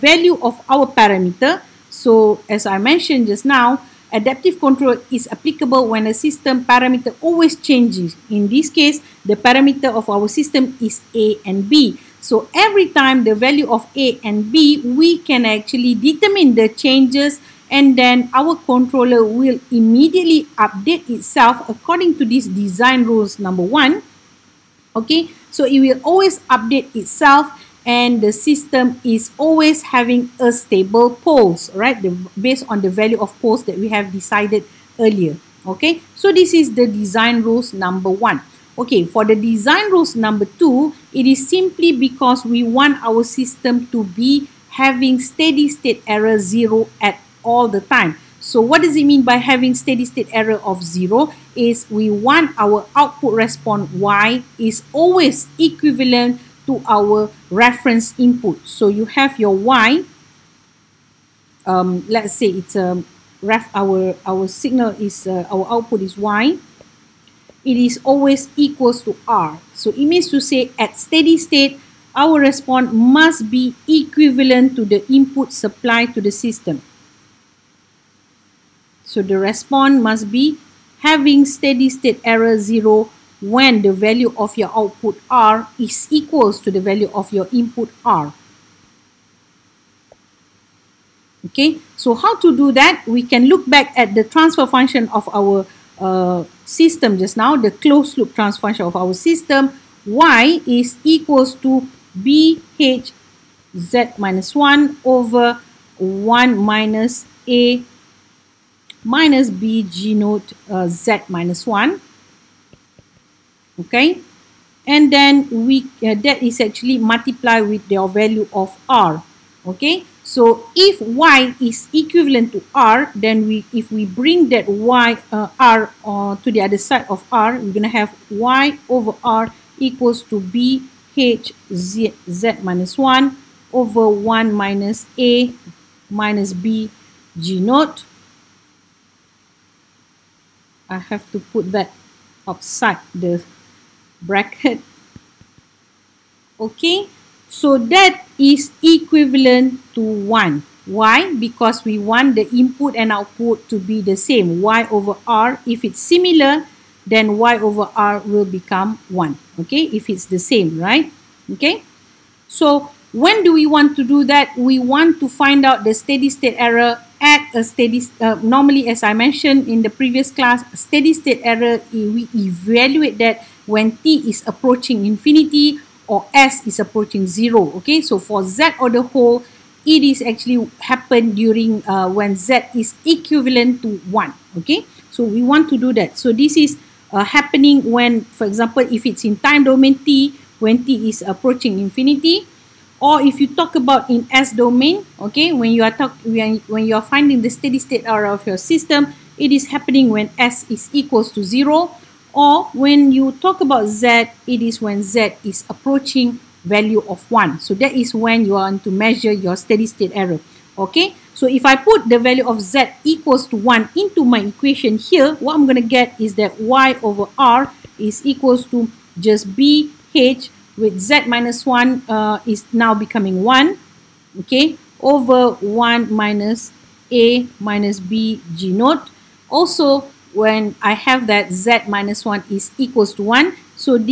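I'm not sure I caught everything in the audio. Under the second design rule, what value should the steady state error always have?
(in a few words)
0.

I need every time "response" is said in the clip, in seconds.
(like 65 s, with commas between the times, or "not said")
53 s, 72 s, 79 s.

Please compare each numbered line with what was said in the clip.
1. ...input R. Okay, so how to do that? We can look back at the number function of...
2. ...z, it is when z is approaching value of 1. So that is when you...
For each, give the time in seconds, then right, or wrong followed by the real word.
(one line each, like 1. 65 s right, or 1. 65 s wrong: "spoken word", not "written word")
1. 87 s wrong: "transfer", not "number"
2. 203 s right.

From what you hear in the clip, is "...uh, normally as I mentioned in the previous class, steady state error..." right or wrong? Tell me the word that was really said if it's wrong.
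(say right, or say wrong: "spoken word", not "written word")
right.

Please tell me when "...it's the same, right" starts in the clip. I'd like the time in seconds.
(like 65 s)
160 s.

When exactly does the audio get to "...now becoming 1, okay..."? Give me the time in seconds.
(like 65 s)
222 s.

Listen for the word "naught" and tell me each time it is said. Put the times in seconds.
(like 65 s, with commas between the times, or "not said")
110 s, 137 s, 228 s.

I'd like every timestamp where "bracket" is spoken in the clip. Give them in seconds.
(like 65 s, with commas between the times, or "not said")
144 s.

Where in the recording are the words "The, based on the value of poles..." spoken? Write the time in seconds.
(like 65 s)
32 s.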